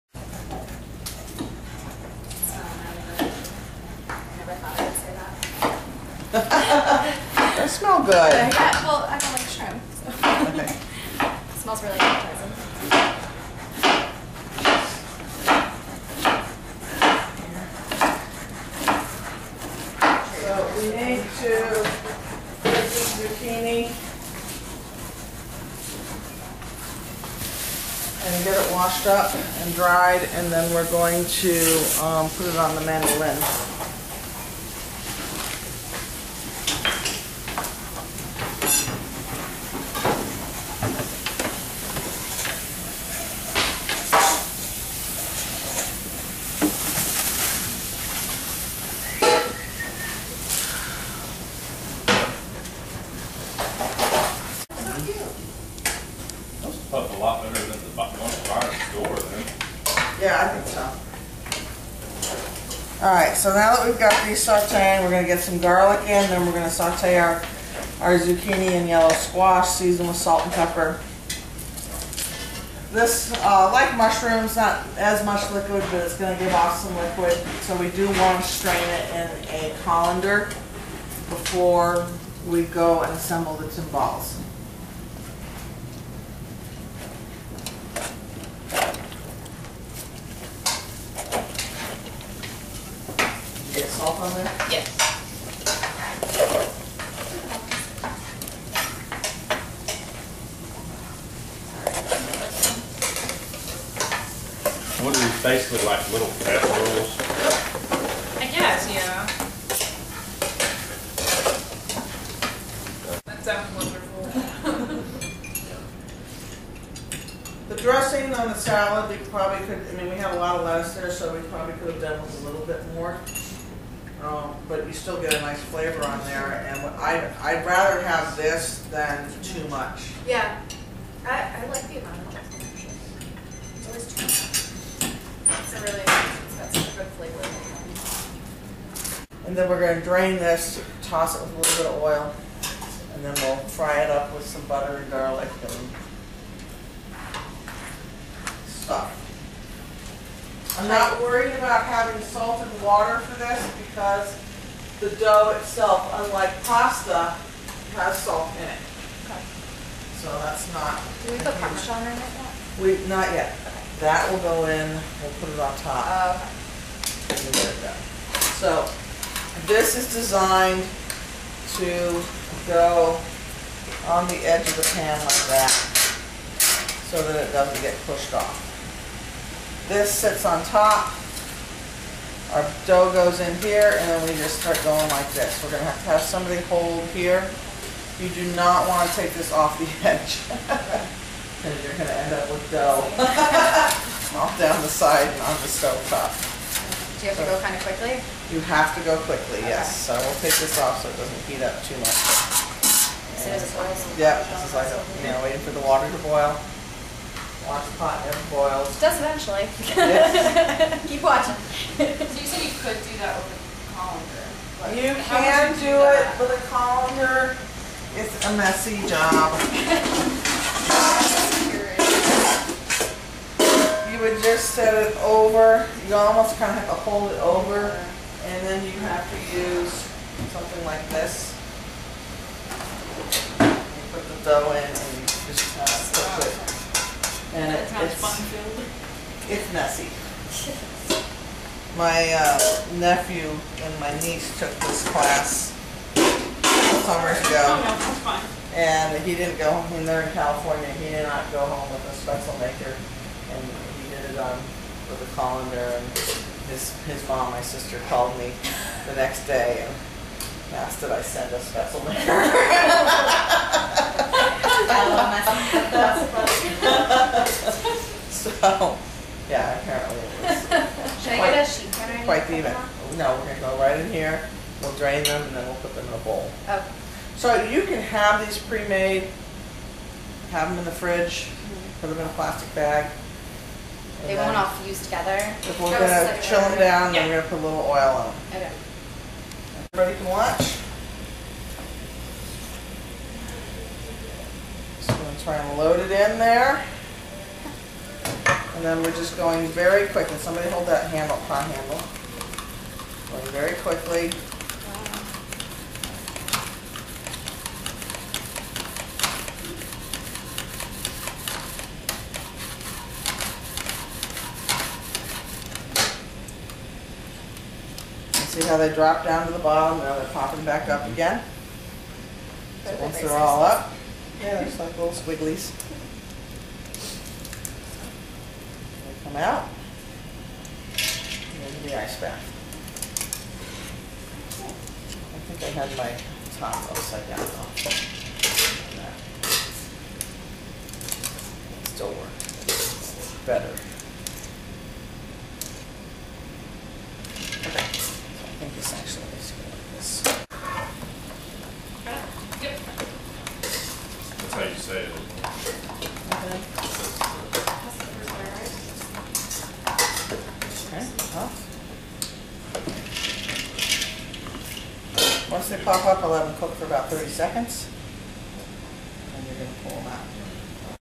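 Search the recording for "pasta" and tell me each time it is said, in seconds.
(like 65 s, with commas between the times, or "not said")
156 s.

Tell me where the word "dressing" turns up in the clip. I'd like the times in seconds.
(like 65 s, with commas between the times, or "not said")
117 s.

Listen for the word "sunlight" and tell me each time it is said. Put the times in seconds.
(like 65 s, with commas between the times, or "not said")
not said.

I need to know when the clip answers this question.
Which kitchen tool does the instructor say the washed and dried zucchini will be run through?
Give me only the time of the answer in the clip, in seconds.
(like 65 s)
32 s.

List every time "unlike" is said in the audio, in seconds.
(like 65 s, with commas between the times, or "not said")
156 s.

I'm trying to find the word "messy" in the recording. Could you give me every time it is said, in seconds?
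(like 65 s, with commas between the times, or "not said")
218 s, 239 s.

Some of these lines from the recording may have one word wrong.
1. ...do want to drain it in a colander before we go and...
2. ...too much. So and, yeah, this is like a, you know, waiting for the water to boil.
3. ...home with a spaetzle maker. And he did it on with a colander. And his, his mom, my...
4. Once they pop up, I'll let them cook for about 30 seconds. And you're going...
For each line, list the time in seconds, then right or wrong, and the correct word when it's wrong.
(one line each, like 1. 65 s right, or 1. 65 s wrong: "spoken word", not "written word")
1. 77 s wrong: "strain", not "drain"
2. 201 s right
3. 251 s right
4. 365 s right.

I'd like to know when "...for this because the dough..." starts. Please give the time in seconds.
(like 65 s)
153 s.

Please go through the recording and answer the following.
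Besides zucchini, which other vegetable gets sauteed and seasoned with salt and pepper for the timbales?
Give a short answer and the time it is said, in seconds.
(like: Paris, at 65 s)
yellow squash, at 68 s.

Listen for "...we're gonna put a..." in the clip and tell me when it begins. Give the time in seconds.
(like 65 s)
287 s.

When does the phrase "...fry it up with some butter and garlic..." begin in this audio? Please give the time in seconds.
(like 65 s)
143 s.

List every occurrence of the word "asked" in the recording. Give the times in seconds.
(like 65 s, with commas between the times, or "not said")
260 s.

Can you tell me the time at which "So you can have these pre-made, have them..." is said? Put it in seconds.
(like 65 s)
277 s.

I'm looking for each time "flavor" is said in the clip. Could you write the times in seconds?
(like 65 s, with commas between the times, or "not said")
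125 s, 137 s.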